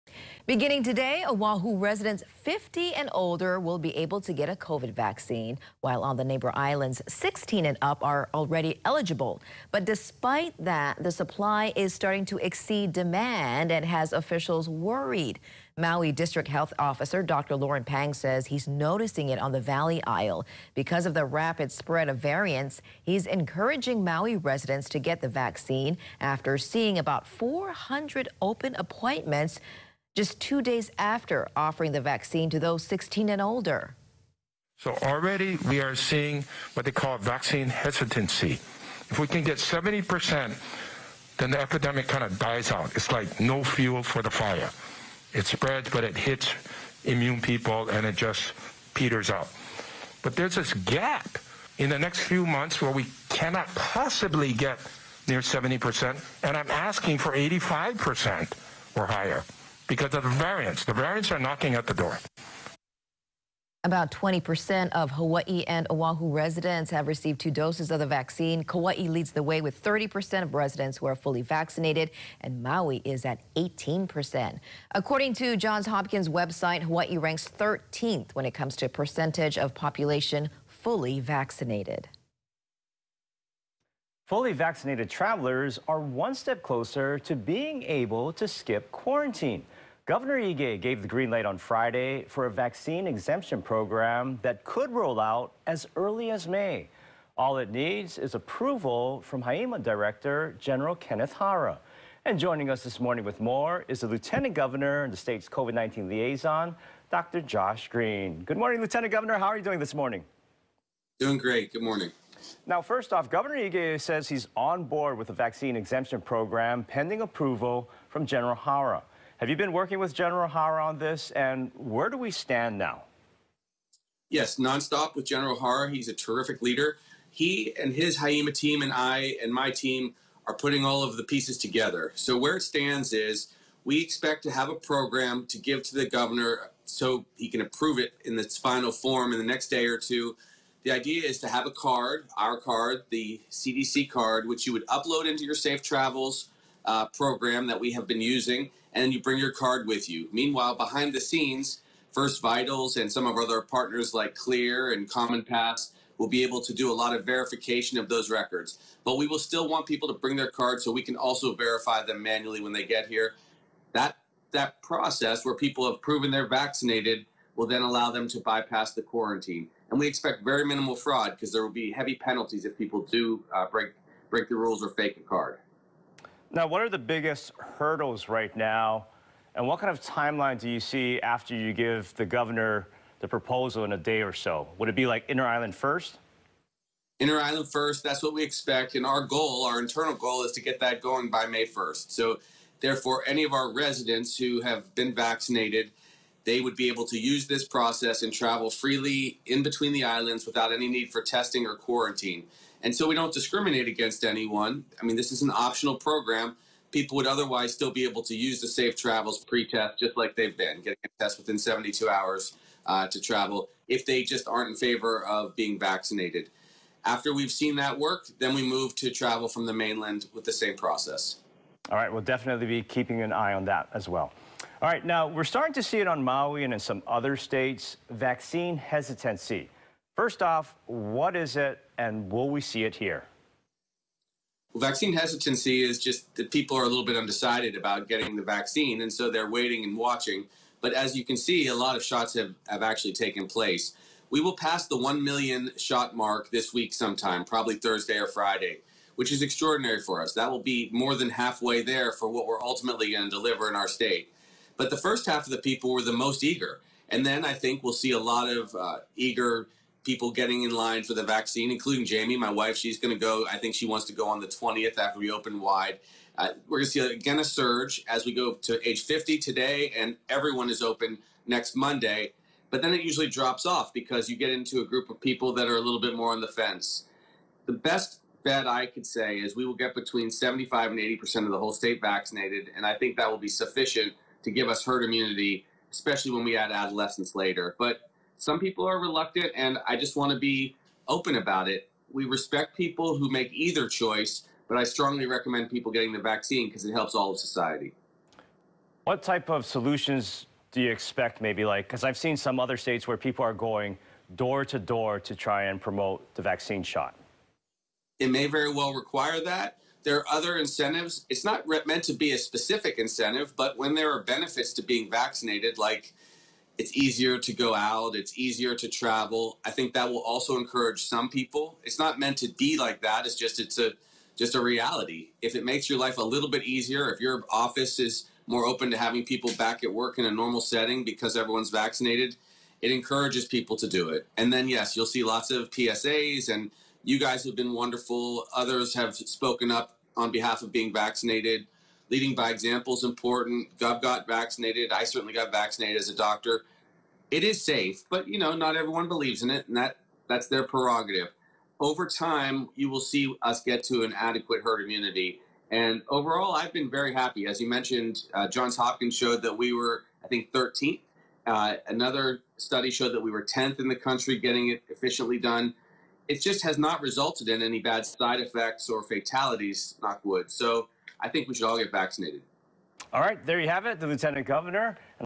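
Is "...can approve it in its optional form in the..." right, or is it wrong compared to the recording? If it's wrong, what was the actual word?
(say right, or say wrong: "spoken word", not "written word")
wrong: "final", not "optional".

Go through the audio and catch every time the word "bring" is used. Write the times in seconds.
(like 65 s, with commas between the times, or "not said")
149 s, 160 s.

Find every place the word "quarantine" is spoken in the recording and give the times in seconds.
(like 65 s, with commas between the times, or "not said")
88 s, 169 s, 201 s.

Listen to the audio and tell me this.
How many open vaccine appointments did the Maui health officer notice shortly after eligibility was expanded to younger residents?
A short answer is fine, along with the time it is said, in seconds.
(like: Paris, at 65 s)
400, at 27 s.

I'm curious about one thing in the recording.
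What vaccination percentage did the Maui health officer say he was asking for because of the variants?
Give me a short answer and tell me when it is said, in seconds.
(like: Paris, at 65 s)
85%, at 57 s.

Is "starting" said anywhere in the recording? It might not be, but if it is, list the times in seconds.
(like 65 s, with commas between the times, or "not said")
11 s, 225 s.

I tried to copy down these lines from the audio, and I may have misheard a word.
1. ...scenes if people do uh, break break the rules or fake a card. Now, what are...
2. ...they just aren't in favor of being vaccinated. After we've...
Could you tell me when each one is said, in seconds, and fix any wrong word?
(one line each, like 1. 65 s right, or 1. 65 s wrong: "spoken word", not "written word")
1. 172 s wrong: "penalties", not "scenes"
2. 214 s right.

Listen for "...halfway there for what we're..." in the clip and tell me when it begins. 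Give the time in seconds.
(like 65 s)
251 s.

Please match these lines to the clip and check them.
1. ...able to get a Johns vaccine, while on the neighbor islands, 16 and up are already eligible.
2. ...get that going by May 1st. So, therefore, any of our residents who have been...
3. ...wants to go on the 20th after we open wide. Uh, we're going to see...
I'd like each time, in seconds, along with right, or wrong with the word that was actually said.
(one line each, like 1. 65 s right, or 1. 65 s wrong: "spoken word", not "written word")
1. 3 s wrong: "COVID", not "Johns"
2. 190 s right
3. 263 s right.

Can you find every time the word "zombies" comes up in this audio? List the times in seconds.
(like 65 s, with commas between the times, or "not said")
not said.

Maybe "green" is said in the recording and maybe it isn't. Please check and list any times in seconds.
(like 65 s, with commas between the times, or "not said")
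91 s, 107 s.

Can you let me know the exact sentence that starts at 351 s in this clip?
Over time, you will see us get to an adequate herd immunity.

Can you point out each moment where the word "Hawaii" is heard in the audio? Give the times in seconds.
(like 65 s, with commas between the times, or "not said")
65 s, 76 s.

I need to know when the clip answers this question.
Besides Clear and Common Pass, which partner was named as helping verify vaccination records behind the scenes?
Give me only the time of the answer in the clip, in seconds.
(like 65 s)
152 s.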